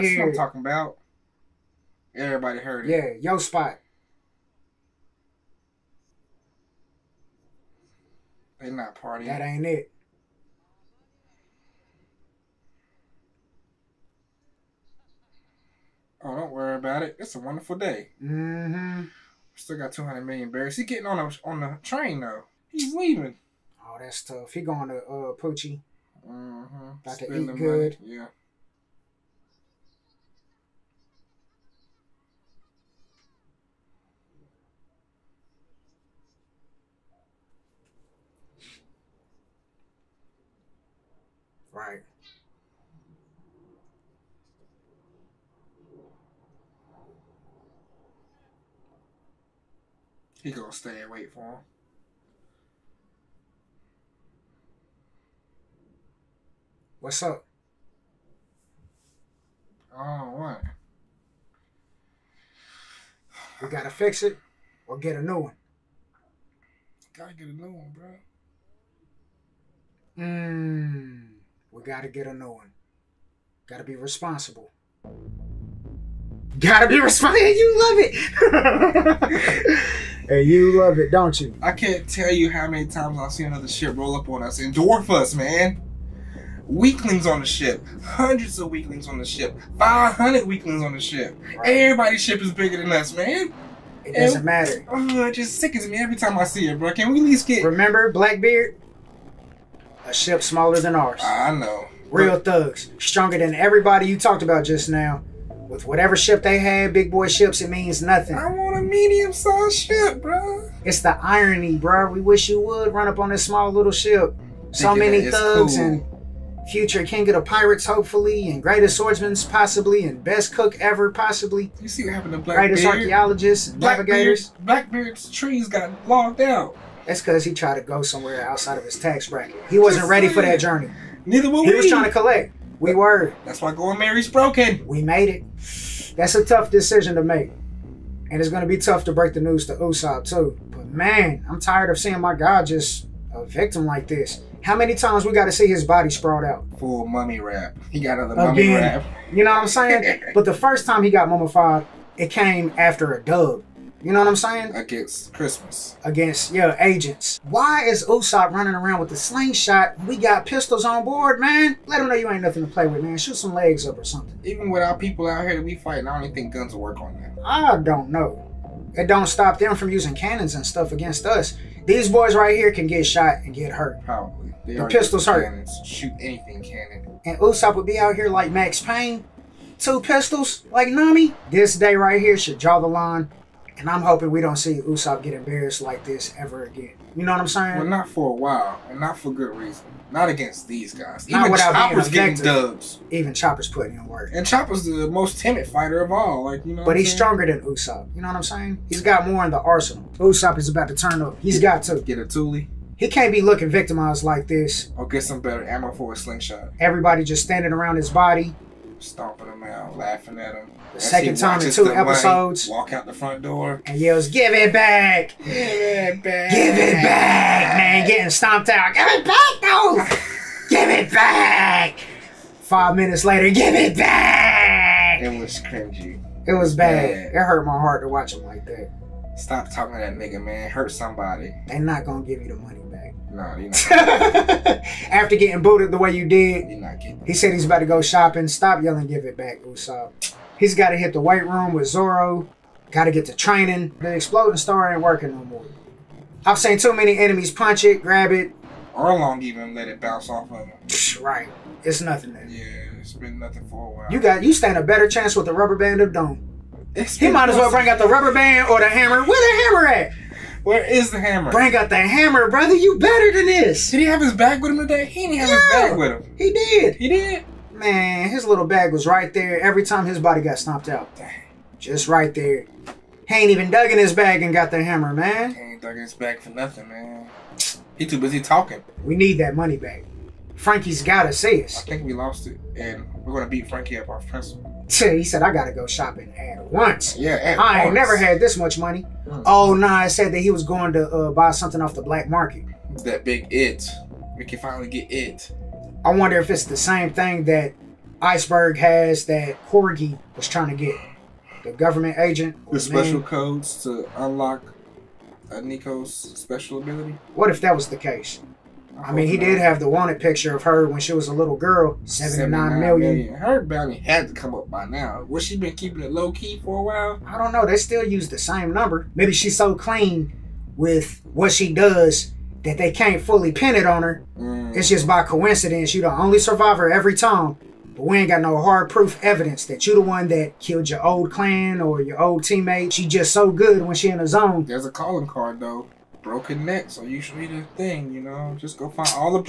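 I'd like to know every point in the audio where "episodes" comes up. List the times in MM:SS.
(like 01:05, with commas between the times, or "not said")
03:31.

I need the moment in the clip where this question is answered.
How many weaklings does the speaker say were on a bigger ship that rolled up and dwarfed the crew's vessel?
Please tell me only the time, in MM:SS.
01:29.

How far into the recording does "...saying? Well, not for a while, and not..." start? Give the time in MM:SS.
03:07.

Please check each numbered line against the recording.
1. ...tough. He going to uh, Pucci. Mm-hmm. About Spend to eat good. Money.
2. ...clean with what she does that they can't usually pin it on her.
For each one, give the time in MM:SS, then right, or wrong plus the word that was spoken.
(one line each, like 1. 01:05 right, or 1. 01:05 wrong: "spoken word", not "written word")
1. 00:24 right
2. 05:19 wrong: "fully", not "usually".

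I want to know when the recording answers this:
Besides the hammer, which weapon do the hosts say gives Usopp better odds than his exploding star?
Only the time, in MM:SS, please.
04:15.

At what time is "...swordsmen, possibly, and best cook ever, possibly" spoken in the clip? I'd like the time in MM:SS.
01:58.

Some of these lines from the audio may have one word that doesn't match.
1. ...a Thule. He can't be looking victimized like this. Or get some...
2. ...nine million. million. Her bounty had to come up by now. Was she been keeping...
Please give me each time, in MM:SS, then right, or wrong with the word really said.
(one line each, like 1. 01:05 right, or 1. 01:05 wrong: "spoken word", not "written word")
1. 03:22 right
2. 05:12 right.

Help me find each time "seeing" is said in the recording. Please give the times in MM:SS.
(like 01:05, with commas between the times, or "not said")
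02:21.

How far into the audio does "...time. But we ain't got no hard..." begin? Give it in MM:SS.
05:27.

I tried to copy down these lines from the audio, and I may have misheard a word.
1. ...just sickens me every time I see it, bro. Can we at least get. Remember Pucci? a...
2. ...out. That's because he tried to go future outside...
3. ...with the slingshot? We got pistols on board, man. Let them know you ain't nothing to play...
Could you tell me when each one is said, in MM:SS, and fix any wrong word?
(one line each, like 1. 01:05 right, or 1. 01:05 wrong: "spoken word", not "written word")
1. 01:35 wrong: "Blackbeard", not "Pucci"
2. 02:06 wrong: "somewhere", not "future"
3. 02:38 right.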